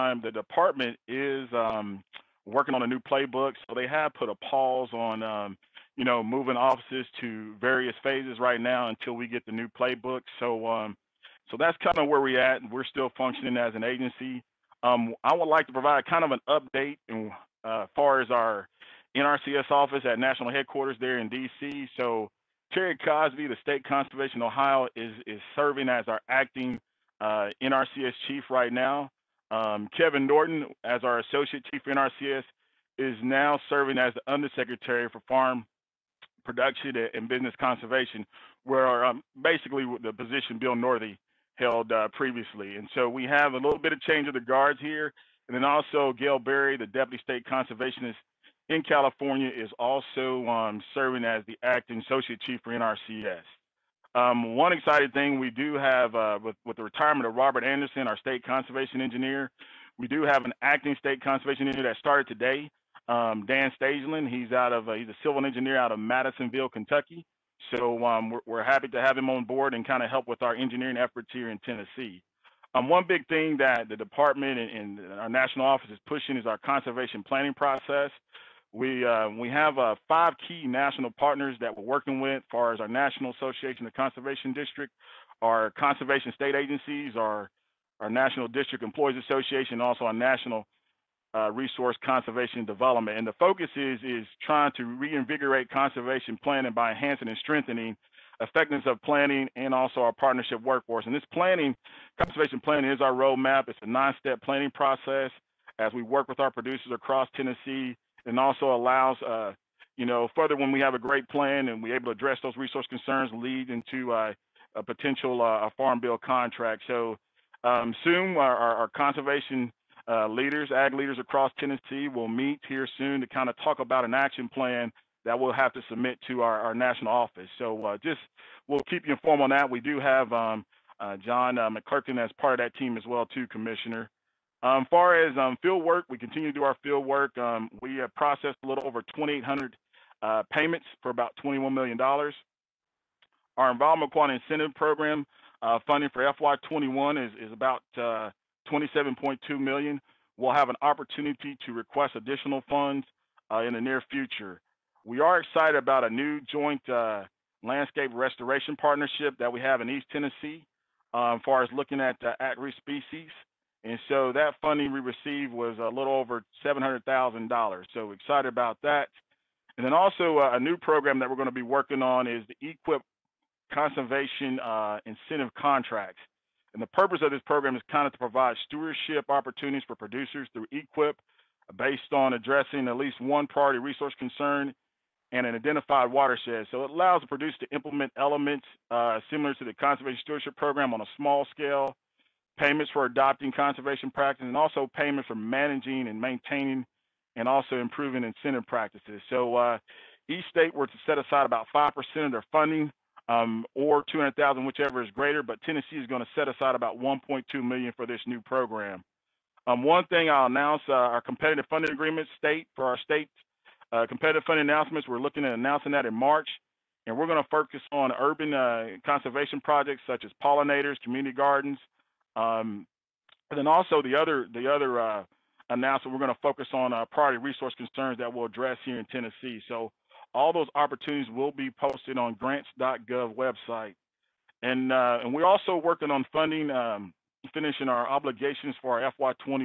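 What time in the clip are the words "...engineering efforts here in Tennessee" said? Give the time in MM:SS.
01:10.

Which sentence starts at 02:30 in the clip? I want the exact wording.
We'll have an opportunity to request additional funds uh, in the near future.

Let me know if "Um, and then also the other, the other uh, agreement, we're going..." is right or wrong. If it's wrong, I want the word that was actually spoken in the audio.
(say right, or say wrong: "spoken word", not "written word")
wrong: "announcement", not "agreement".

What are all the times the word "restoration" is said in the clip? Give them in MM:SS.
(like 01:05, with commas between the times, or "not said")
02:38.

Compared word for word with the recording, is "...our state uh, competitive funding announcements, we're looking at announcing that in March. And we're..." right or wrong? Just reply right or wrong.
right.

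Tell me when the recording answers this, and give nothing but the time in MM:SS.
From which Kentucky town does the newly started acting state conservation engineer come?
01:05.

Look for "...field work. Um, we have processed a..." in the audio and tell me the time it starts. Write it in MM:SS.
02:16.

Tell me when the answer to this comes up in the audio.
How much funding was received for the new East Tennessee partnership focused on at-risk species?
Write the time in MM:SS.
02:45.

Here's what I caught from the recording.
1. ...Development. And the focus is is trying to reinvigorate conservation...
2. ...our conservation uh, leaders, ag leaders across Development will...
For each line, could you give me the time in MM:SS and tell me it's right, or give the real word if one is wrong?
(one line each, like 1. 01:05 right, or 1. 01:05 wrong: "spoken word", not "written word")
1. 01:32 right
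2. 01:58 wrong: "Tennessee", not "Development".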